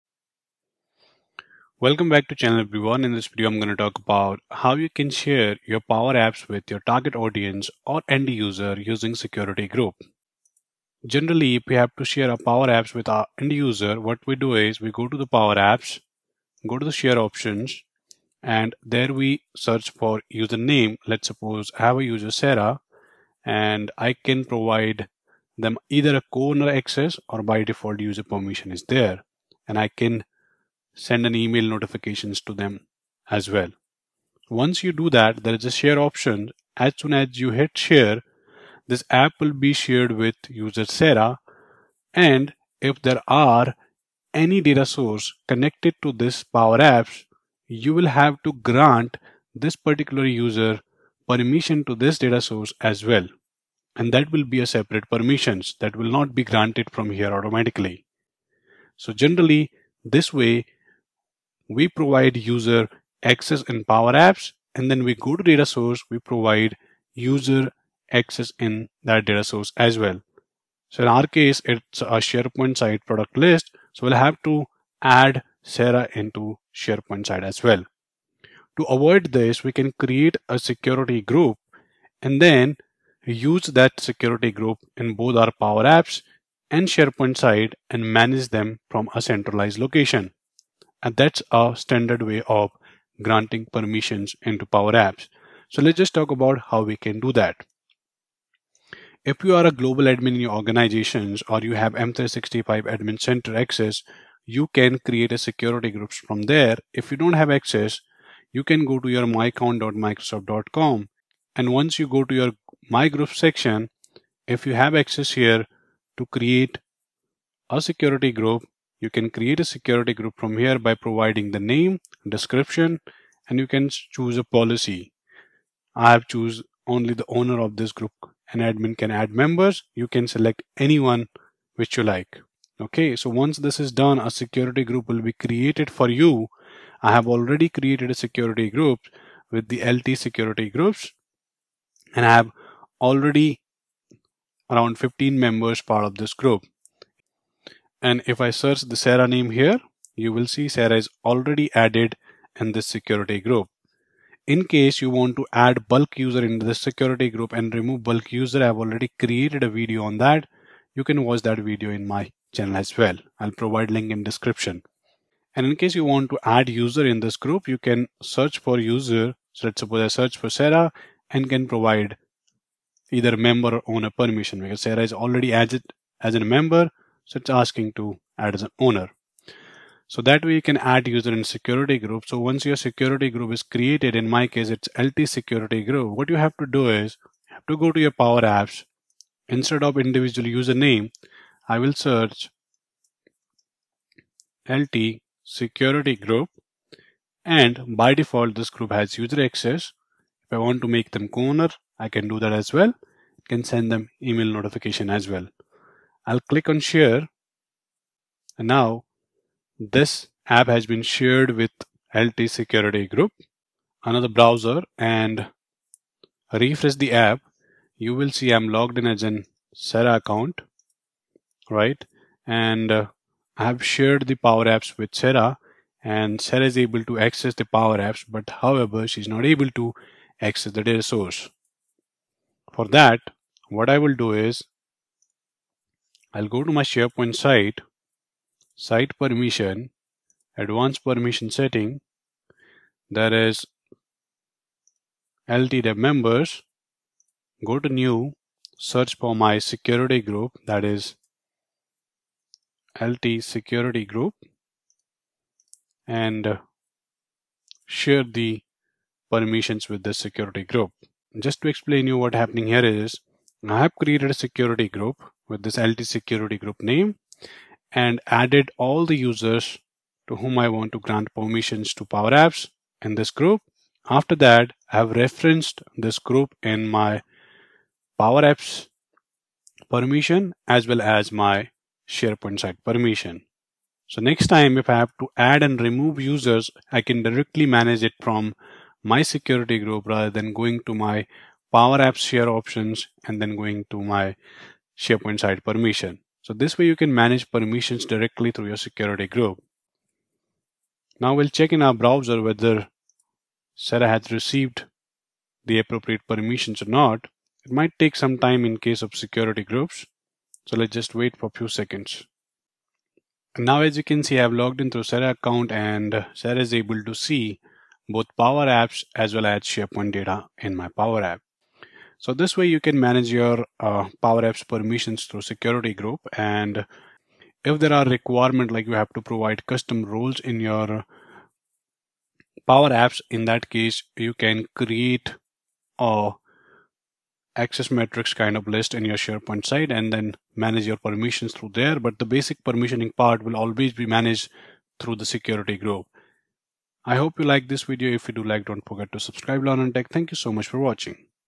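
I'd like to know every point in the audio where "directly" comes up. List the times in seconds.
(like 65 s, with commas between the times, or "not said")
287 s, 298 s.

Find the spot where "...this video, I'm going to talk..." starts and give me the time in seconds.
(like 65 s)
3 s.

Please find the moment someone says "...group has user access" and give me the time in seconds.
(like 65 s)
198 s.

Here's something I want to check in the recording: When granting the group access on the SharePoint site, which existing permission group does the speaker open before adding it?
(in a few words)
LTDEV members.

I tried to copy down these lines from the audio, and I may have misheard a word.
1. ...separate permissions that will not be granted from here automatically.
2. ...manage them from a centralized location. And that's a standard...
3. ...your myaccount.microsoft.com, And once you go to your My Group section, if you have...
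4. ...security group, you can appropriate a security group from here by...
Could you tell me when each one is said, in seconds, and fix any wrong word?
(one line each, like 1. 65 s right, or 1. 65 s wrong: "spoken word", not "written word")
1. 54 s right
2. 88 s right
3. 109 s right
4. 117 s wrong: "create", not "appropriate".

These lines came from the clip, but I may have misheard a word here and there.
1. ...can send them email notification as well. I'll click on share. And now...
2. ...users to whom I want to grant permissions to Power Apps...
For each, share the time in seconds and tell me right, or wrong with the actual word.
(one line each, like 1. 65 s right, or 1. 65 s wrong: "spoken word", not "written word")
1. 203 s right
2. 269 s right.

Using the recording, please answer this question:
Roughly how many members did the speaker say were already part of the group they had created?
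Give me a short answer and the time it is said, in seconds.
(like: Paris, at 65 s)
15, at 144 s.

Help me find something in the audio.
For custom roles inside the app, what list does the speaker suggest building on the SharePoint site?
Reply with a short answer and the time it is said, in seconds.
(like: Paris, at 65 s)
access metrics, at 337 s.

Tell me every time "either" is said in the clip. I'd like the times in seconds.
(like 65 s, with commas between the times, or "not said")
25 s, 173 s.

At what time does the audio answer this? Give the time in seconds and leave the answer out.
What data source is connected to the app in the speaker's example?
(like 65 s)
73 s.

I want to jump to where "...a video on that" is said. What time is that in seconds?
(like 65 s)
159 s.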